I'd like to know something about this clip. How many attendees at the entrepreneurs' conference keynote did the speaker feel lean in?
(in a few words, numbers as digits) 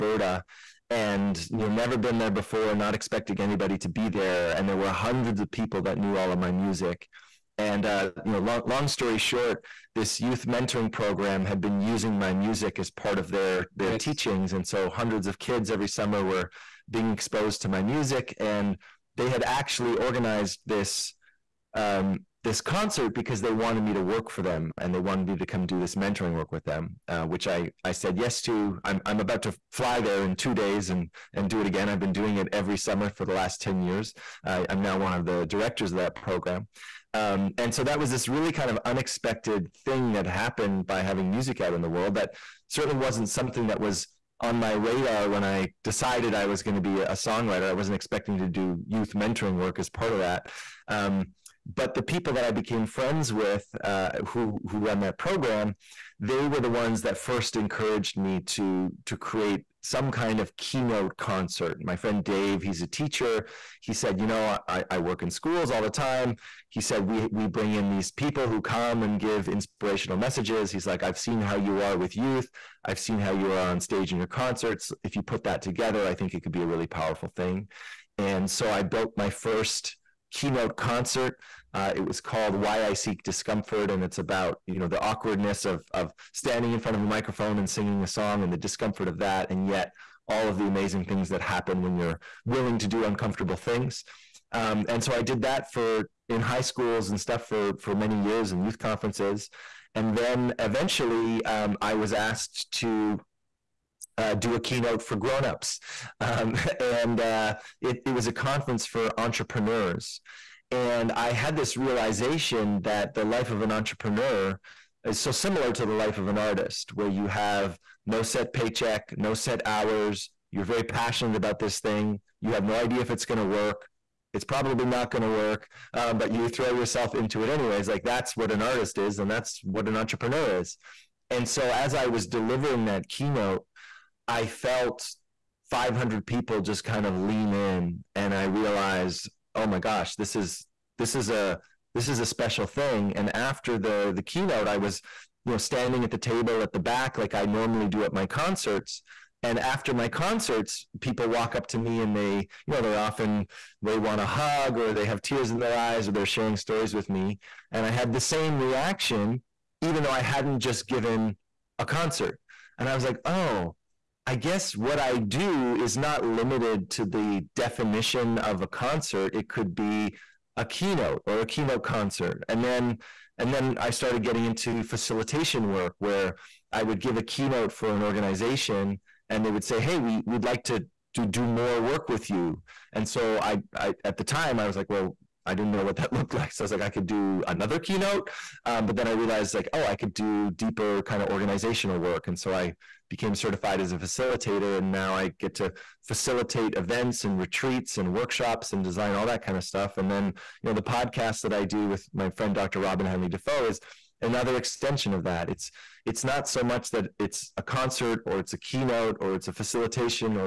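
500.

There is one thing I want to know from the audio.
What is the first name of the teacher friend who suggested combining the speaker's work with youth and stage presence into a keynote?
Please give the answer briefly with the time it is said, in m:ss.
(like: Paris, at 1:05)
Dave, at 1:02.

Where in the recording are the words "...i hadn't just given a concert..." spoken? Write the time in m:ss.
2:40.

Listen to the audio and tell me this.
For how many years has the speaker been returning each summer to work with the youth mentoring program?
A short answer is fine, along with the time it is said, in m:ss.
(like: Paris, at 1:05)
10, at 0:33.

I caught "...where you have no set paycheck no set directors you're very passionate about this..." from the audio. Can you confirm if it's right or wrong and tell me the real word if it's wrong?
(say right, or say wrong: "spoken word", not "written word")
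wrong: "hours", not "directors".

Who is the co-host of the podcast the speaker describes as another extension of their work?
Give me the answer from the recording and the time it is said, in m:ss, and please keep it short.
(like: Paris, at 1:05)
Dr. Robyn Hanley-Dafoe, at 3:22.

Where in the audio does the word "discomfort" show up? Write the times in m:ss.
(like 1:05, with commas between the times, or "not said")
1:23, 1:28.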